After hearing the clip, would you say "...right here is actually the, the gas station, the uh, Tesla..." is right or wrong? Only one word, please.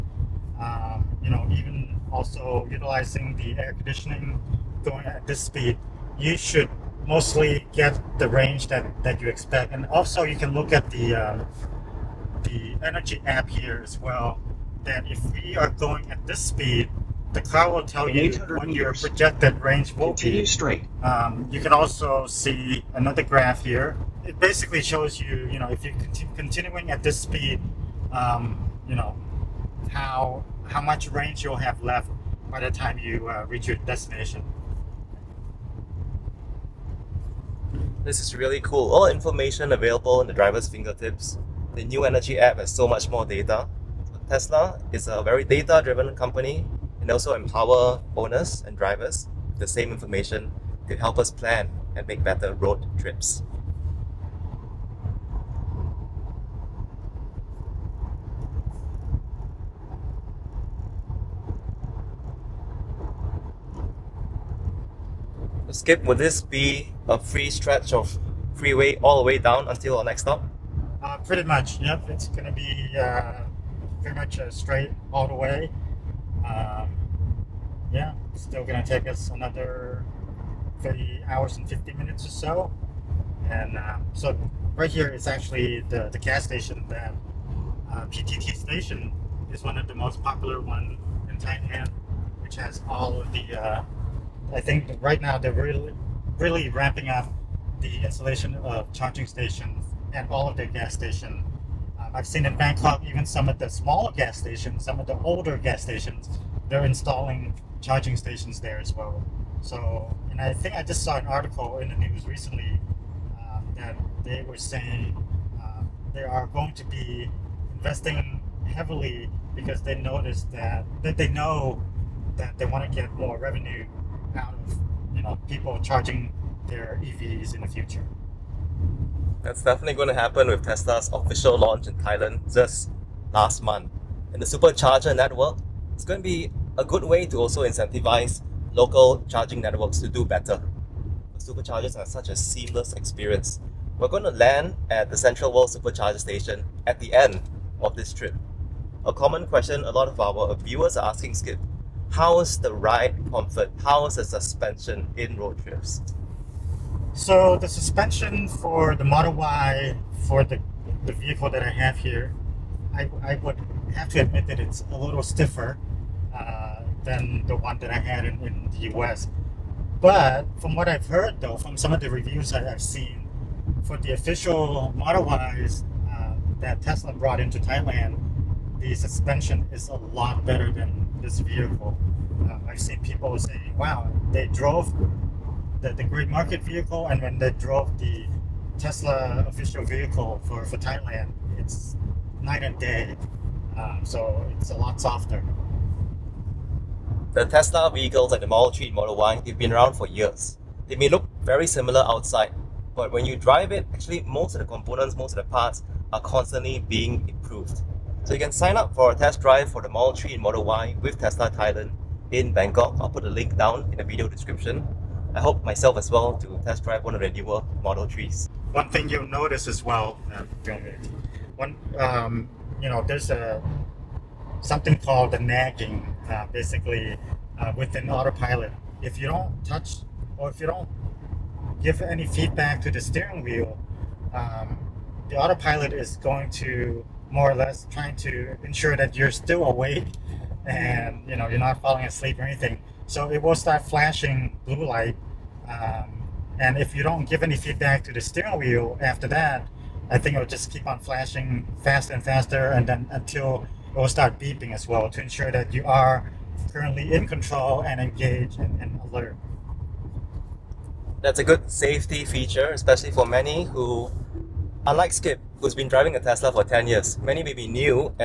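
wrong.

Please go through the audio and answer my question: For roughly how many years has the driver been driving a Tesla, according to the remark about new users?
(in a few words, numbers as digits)
10 years.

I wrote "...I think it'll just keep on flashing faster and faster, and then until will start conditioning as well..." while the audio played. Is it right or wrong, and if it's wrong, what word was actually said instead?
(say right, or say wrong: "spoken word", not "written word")
wrong: "beeping", not "conditioning".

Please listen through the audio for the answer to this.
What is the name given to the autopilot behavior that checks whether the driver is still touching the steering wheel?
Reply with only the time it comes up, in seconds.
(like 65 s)
225 s.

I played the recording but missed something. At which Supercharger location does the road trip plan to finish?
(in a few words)
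Central World.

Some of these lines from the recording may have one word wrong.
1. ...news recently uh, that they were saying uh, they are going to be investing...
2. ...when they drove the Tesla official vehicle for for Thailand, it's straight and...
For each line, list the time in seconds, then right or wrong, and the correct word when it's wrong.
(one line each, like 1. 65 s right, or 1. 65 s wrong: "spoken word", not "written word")
1. 111 s right
2. 187 s wrong: "night", not "straight".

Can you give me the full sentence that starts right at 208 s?
So you can sign up for a test drive for the Model 3 and Model Y with Tesla Thailand in Bangkok.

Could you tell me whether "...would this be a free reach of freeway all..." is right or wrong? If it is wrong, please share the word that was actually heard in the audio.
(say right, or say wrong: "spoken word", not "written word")
wrong: "stretch", not "reach".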